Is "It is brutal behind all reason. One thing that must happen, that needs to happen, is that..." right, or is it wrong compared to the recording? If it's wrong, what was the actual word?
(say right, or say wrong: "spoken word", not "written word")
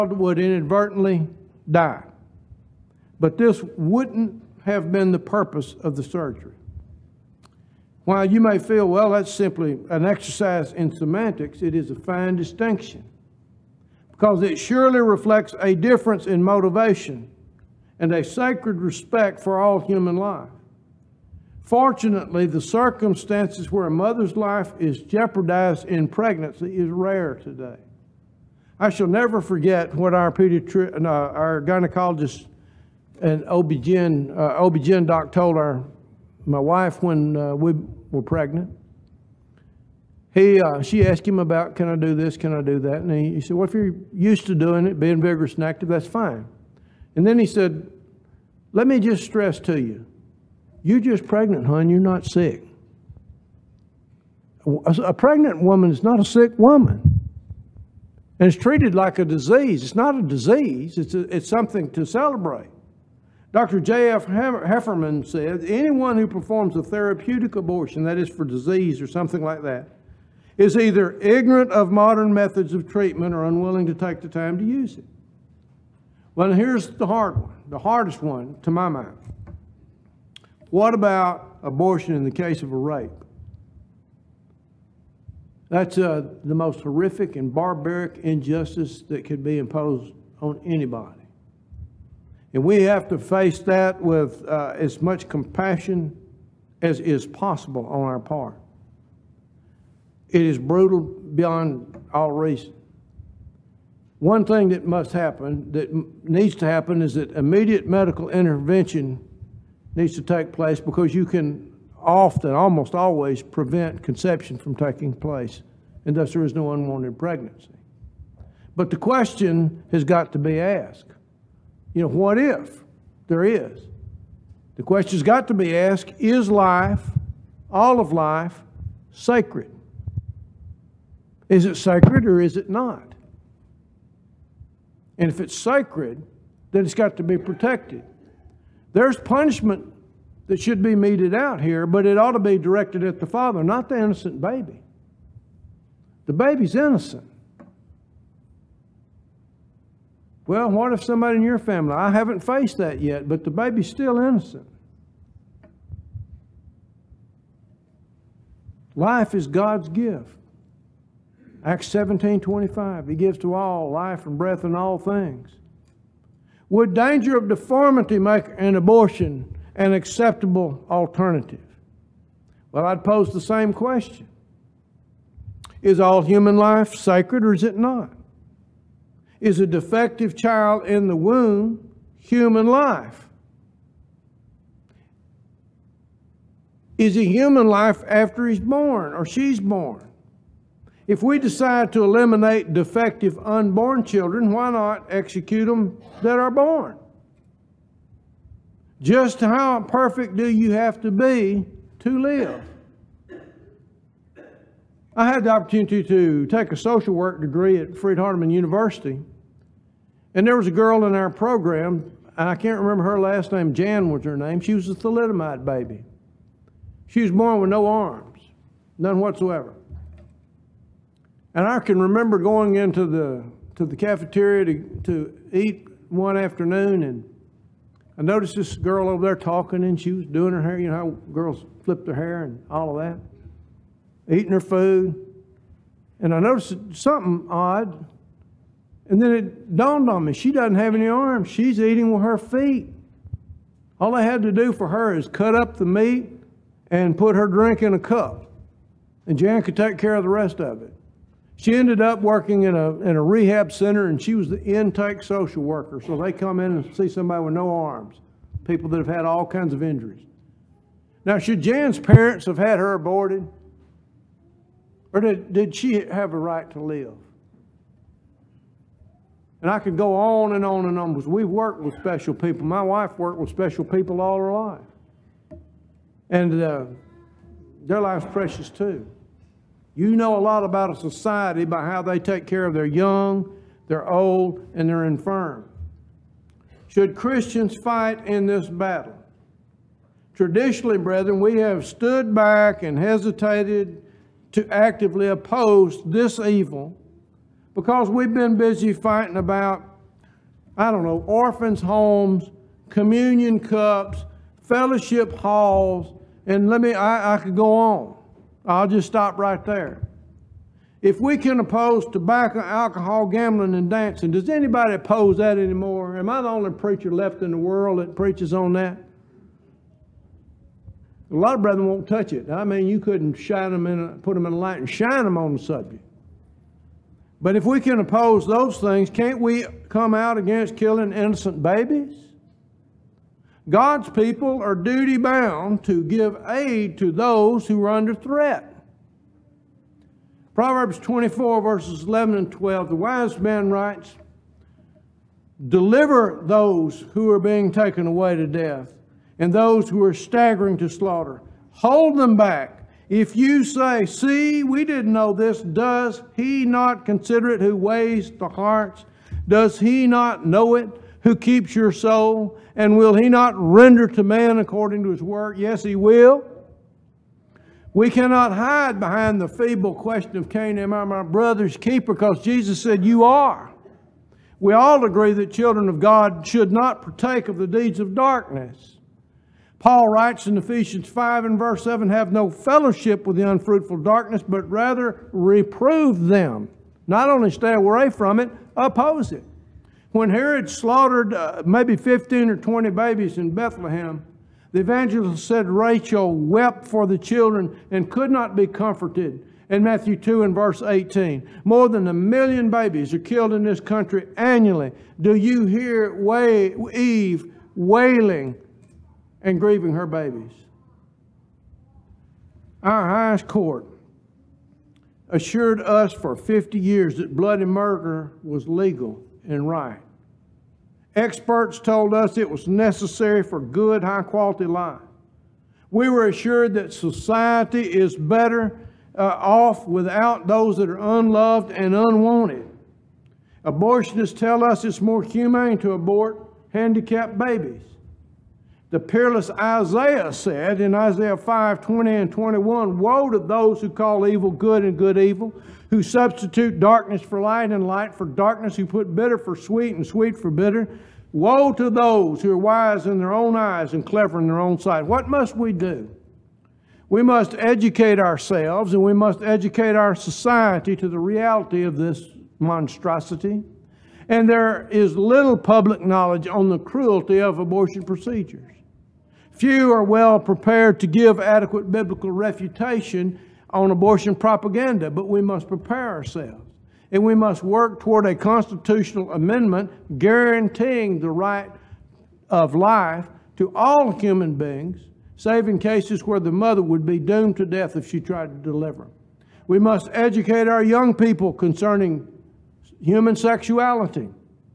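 wrong: "beyond", not "behind".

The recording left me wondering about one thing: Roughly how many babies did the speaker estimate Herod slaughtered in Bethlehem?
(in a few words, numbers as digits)
15 or 20.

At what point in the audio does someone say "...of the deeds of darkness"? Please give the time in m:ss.
6:17.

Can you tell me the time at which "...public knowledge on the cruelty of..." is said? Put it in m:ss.
7:45.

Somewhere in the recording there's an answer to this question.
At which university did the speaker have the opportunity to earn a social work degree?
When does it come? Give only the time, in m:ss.
3:27.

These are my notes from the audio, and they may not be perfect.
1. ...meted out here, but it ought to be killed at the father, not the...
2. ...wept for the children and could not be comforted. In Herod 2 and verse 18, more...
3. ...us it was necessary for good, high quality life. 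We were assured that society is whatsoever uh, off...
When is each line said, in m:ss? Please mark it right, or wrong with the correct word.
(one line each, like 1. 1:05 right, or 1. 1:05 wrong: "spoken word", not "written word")
1. 2:20 wrong: "directed", not "killed"
2. 6:36 wrong: "Matthew", not "Herod"
3. 7:02 wrong: "better", not "whatsoever".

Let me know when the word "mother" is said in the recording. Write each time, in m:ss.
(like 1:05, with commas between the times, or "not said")
0:23, 8:06.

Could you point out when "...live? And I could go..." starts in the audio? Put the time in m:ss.
4:26.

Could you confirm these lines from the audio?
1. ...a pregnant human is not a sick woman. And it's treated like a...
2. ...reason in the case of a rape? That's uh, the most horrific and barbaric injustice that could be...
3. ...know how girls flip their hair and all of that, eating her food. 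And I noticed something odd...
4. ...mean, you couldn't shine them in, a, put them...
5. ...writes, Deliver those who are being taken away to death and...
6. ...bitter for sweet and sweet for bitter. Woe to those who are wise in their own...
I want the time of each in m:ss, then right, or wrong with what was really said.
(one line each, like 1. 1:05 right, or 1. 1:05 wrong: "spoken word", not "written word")
1. 0:55 wrong: "woman", not "human"
2. 1:21 wrong: "abortion", not "reason"
3. 3:50 right
4. 5:22 right
5. 5:43 right
6. 7:29 right.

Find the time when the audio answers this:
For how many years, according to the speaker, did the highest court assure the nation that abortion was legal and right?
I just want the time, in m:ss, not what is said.
6:56.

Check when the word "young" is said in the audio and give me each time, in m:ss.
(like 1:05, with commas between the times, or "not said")
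4:42, 8:10.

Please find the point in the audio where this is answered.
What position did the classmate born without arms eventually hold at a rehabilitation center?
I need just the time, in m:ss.
4:14.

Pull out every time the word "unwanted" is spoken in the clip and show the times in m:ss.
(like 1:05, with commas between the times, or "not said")
1:56, 7:11.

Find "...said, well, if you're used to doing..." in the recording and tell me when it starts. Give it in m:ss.
0:43.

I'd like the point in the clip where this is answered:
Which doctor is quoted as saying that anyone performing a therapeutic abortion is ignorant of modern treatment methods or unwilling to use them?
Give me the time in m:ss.
1:03.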